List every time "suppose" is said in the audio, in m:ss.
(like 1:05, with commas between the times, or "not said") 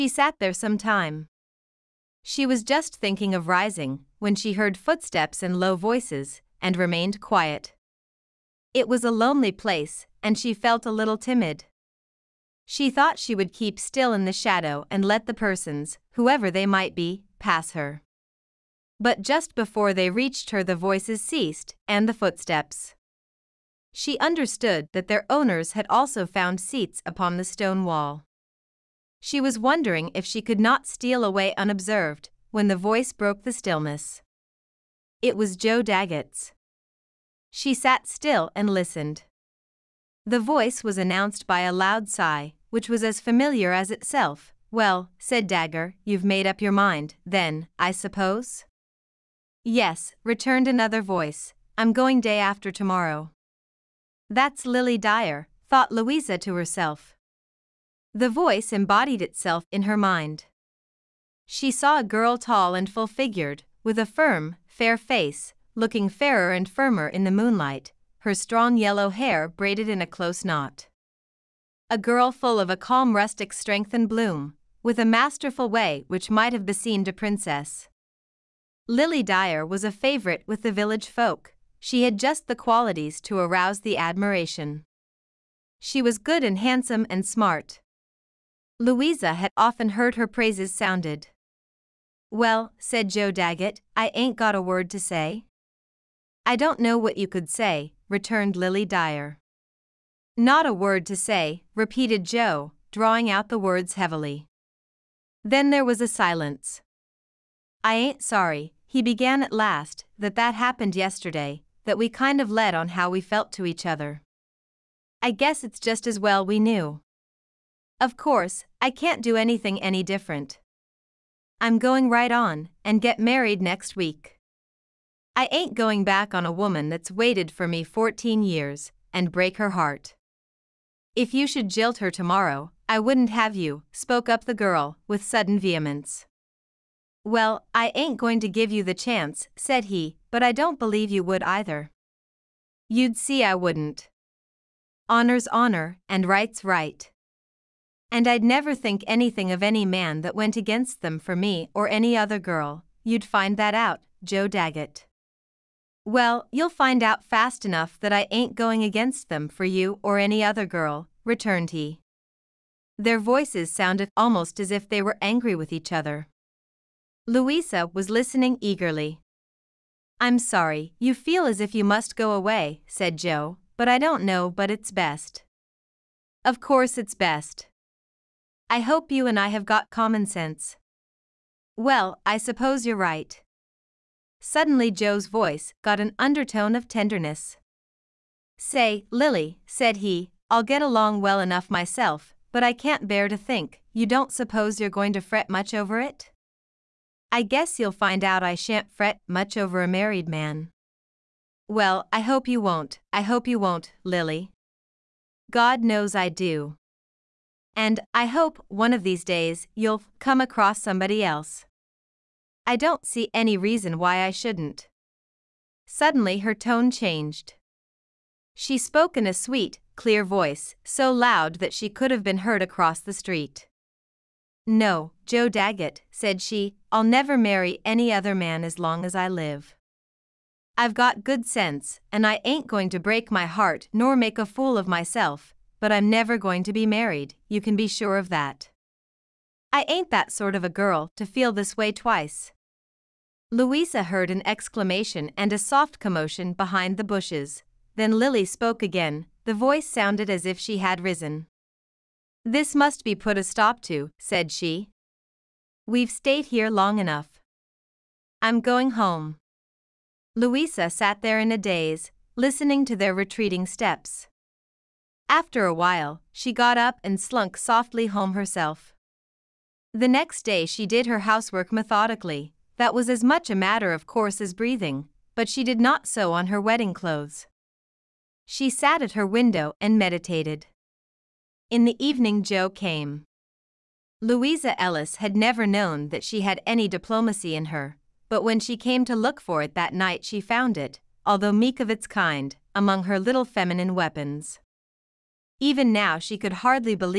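0:47, 3:02, 3:14.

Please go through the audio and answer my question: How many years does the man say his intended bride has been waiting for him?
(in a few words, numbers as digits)
14.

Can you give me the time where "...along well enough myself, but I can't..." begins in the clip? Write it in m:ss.
3:10.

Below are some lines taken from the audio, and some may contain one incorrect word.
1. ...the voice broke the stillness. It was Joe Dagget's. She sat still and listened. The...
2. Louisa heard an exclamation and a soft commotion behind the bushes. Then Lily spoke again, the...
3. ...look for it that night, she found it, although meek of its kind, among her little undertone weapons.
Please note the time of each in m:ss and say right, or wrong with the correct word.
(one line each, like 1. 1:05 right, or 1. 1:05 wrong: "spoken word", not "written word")
1. 0:32 right
2. 4:03 right
3. 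4:49 wrong: "feminine", not "undertone".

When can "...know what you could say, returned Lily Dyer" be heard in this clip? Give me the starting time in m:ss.
1:36.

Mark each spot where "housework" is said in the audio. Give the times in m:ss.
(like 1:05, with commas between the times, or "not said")
4:31.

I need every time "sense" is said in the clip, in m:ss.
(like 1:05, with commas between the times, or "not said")
3:00, 3:51.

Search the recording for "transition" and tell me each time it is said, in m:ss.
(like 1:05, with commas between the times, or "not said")
not said.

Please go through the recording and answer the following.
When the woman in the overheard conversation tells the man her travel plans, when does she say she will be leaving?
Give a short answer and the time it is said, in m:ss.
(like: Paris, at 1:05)
day after tomorrow, at 0:52.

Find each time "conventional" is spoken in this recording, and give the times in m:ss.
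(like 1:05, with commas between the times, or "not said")
not said.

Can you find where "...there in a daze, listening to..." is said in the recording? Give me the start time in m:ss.
4:21.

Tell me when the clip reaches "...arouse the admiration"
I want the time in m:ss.
1:23.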